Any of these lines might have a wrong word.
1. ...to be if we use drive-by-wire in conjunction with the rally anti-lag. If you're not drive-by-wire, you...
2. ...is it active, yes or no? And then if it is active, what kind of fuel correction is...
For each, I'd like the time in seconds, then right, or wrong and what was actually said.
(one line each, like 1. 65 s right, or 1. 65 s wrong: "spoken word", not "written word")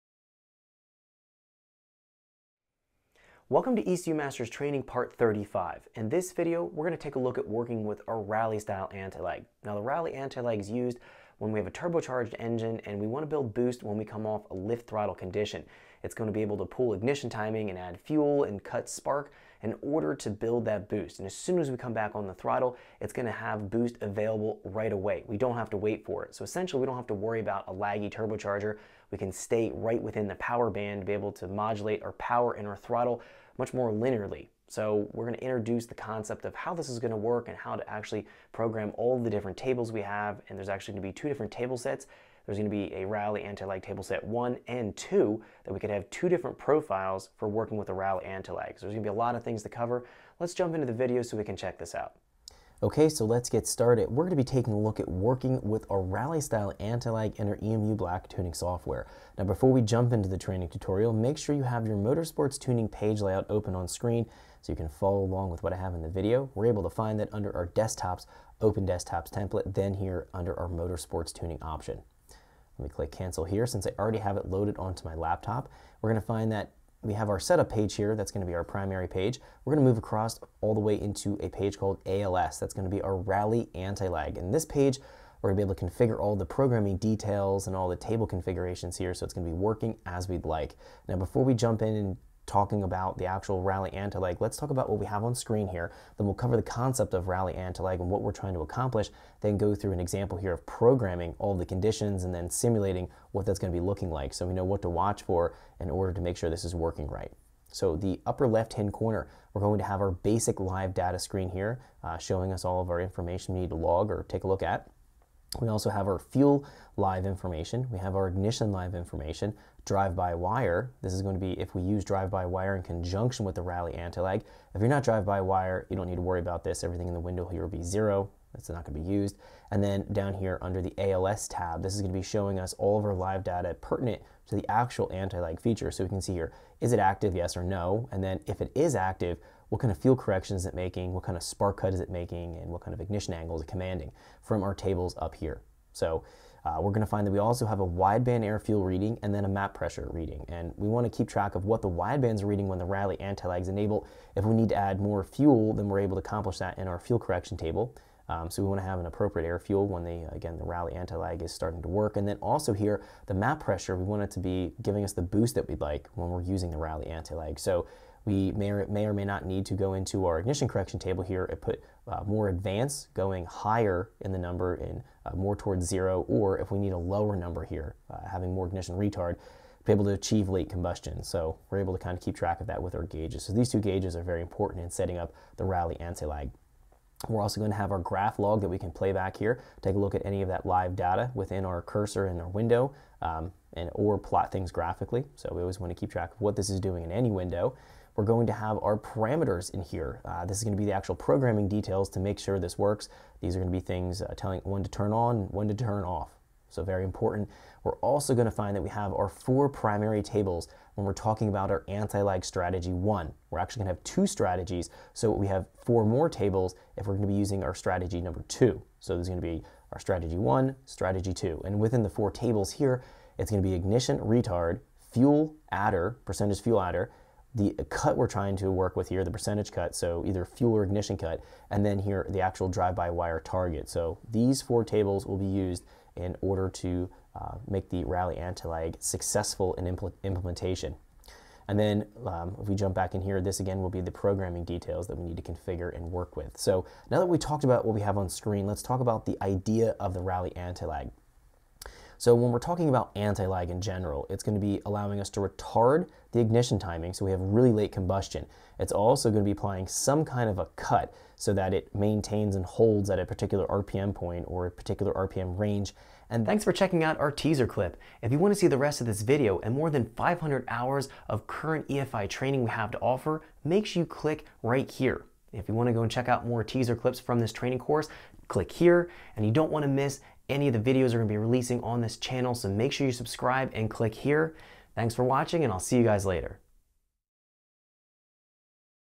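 1. 121 s right
2. 136 s right.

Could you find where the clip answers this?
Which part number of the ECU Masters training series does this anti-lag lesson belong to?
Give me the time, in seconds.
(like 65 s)
4 s.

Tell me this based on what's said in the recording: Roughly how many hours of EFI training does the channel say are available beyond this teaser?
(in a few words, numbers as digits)
500 hours.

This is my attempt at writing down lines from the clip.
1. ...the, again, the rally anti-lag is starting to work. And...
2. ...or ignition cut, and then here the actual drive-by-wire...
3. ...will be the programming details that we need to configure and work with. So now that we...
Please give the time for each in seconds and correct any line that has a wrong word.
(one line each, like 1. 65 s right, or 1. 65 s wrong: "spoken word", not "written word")
1. 160 s right
2. 230 s right
3. 243 s right.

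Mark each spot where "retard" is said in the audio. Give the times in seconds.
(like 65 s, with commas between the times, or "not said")
178 s, 224 s, 255 s.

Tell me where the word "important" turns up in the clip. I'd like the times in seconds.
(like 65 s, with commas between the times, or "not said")
184 s, 207 s.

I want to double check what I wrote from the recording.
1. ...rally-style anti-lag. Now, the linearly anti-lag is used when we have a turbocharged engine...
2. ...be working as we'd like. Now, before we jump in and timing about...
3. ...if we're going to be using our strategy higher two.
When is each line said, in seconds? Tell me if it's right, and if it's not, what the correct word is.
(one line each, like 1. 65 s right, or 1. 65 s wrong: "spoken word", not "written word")
1. 8 s wrong: "rally", not "linearly"
2. 89 s wrong: "talking", not "timing"
3. 216 s wrong: "number", not "higher".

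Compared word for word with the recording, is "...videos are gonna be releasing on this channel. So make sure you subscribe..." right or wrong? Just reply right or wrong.
right.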